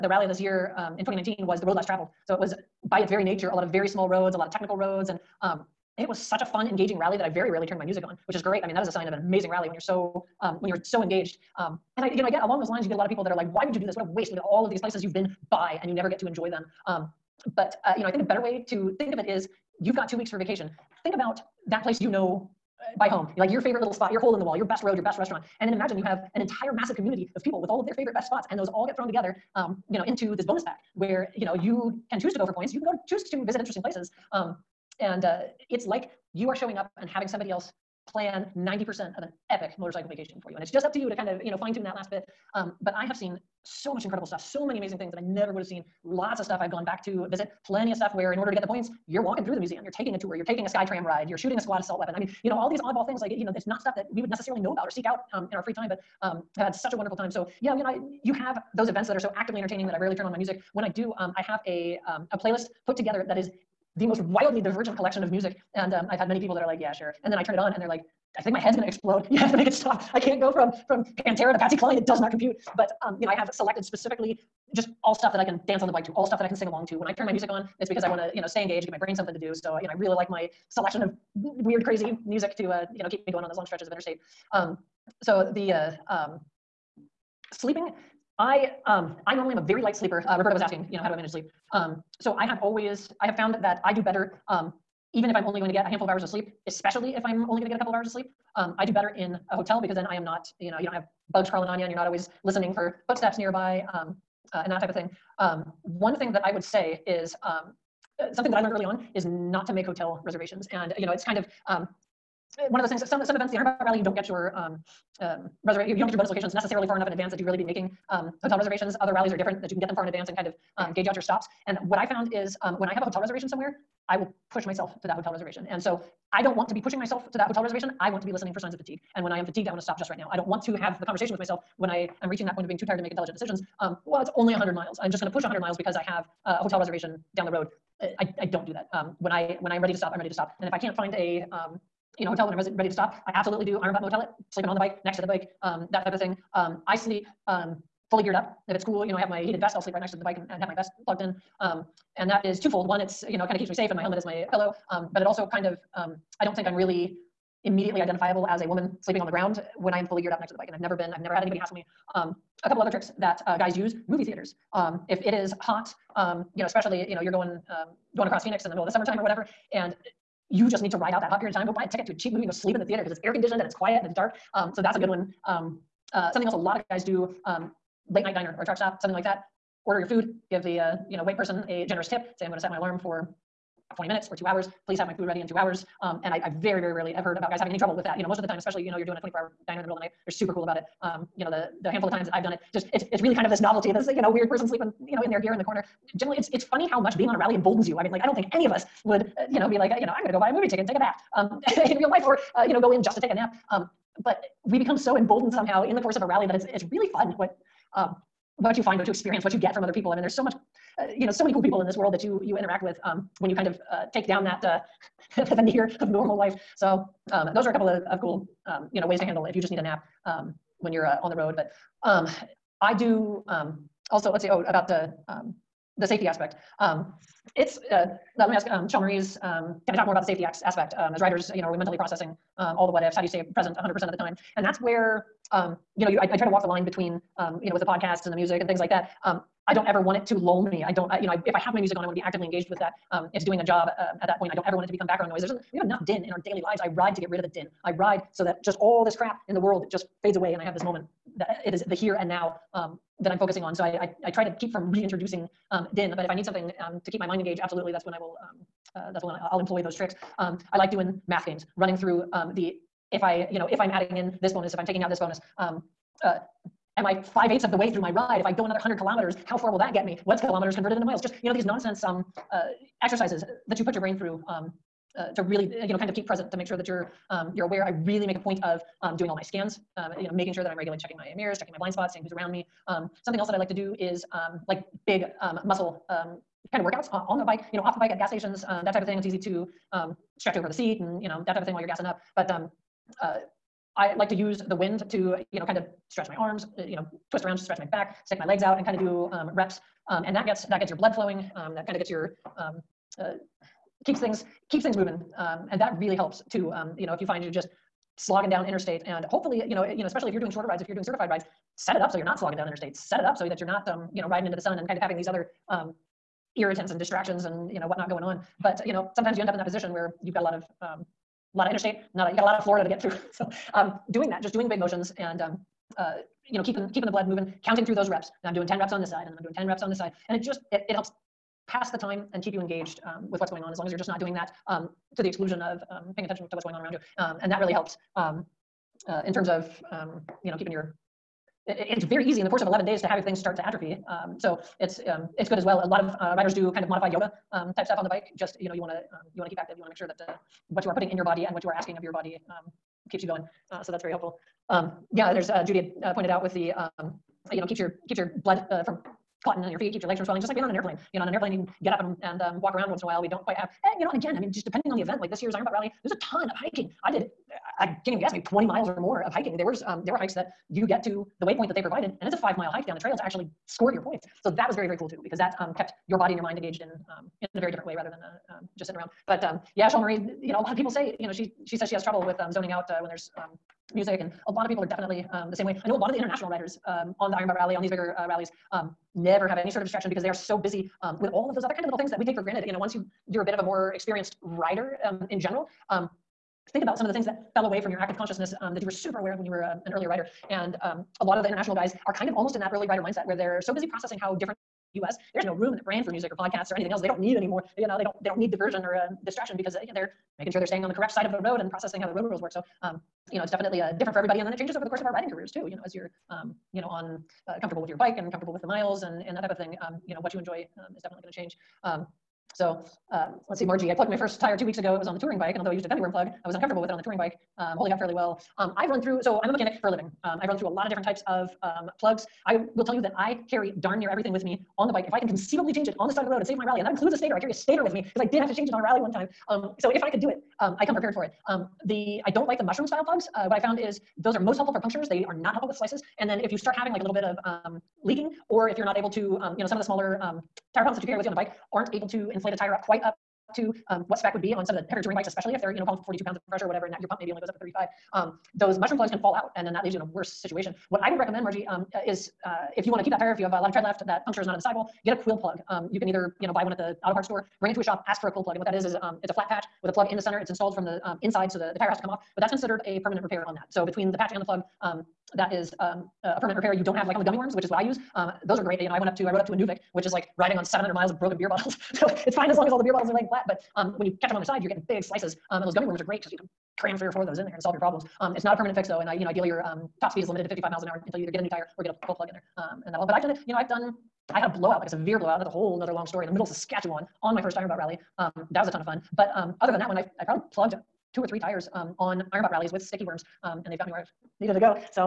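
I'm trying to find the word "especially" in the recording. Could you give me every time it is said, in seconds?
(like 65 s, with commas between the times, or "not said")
96 s, 166 s, 188 s, 310 s, 455 s.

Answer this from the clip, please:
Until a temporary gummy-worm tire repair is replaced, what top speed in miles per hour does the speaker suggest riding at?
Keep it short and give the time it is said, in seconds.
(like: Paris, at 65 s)
55, at 490 s.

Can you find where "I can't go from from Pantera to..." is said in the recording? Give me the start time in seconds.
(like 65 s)
70 s.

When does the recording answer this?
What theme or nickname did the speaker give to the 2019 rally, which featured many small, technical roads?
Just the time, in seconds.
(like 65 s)
1 s.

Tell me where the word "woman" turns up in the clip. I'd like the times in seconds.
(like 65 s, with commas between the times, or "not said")
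158 s.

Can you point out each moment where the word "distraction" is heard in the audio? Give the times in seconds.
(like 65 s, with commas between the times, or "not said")
316 s, 389 s, 409 s.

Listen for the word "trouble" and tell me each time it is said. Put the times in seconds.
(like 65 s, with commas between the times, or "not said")
187 s, 382 s.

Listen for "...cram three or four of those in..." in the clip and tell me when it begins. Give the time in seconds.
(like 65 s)
486 s.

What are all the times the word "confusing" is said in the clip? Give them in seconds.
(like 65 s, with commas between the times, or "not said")
not said.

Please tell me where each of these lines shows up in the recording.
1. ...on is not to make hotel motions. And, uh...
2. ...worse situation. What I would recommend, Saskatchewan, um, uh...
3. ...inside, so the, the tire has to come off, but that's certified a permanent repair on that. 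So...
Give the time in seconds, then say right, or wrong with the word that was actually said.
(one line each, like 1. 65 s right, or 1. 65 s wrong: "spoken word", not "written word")
1. 108 s wrong: "reservations", not "motions"
2. 460 s wrong: "Margie", not "Saskatchewan"
3. 471 s wrong: "considered", not "certified".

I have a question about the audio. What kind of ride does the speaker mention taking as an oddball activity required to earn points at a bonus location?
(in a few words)
sky tram ride.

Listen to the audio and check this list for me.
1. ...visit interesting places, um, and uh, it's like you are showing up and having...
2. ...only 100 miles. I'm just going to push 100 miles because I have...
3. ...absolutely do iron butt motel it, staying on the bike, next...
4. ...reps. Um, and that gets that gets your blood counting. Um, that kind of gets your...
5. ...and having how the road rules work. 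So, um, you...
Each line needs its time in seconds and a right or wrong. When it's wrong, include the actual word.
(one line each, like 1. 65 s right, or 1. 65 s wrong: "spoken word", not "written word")
1. 33 s right
2. 134 s right
3. 143 s wrong: "sleeping", not "staying"
4. 299 s wrong: "flowing", not "counting"
5. 411 s wrong: "processing", not "having".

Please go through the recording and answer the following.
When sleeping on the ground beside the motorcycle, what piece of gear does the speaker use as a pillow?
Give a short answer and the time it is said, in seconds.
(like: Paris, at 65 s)
helmet, at 153 s.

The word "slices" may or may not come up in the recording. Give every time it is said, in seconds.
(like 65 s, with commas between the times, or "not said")
445 s, 485 s.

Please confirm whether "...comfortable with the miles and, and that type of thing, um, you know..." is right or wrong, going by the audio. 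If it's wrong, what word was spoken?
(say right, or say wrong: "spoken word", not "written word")
right.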